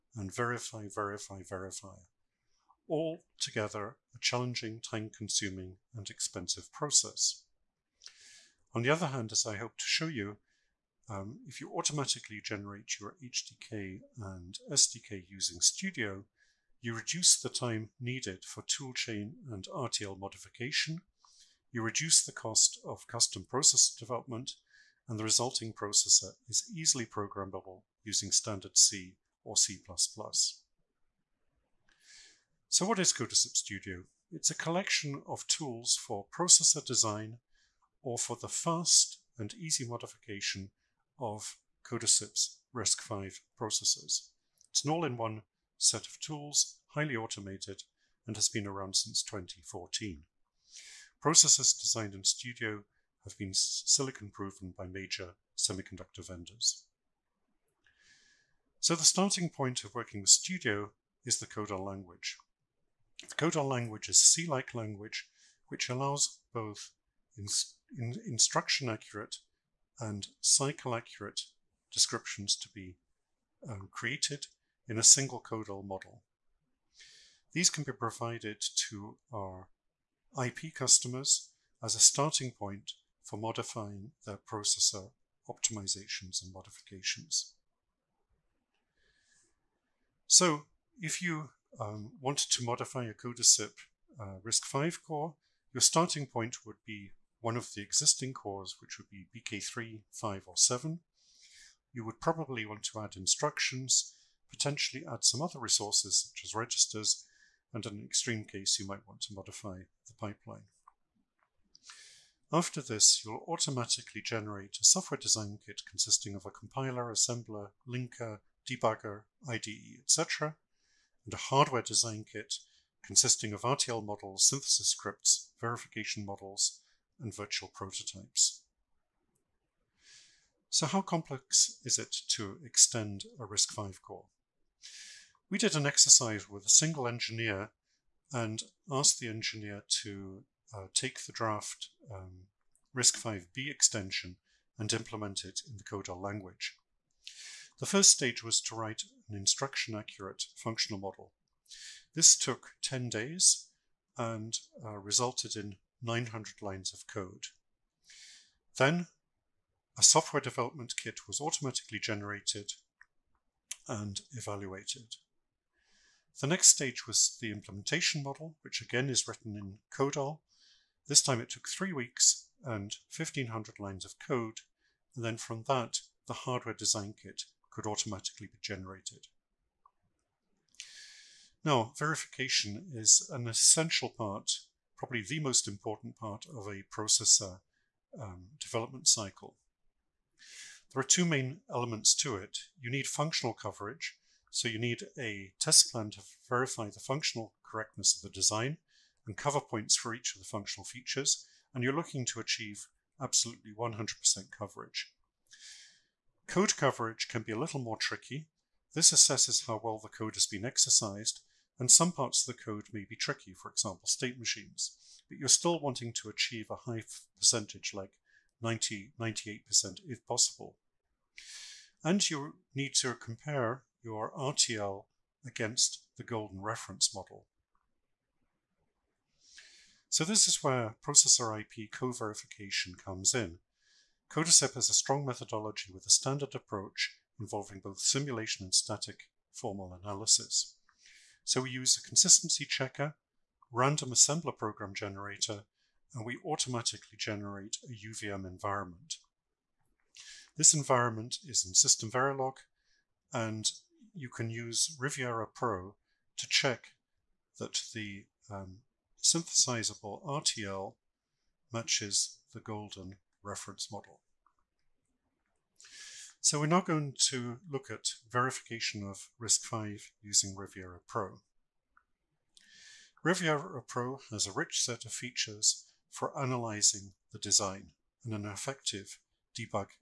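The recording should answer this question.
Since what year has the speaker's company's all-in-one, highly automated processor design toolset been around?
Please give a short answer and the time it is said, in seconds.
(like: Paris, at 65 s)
2014, at 49 s.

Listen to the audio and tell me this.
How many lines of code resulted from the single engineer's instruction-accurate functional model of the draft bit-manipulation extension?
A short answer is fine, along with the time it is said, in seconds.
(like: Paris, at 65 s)
900, at 156 s.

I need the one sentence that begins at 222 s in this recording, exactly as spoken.
And you need to compare your RTL against the golden reference model.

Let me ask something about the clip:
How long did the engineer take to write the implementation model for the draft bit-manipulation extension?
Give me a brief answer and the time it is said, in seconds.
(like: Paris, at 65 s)
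3 weeks, at 171 s.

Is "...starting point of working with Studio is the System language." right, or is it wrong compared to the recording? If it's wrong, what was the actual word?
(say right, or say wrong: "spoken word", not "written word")
wrong: "CodAL", not "System".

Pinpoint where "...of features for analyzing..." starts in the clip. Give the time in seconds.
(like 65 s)
275 s.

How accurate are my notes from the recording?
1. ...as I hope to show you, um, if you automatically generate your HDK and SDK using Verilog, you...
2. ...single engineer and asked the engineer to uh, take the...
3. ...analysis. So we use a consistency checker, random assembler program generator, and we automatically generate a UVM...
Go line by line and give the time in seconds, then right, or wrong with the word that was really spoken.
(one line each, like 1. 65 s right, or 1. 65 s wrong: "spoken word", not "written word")
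1. 9 s wrong: "Studio", not "Verilog"
2. 136 s right
3. 240 s right.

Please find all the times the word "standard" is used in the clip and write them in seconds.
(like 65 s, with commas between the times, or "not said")
28 s, 236 s.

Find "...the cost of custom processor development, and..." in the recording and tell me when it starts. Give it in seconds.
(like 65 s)
22 s.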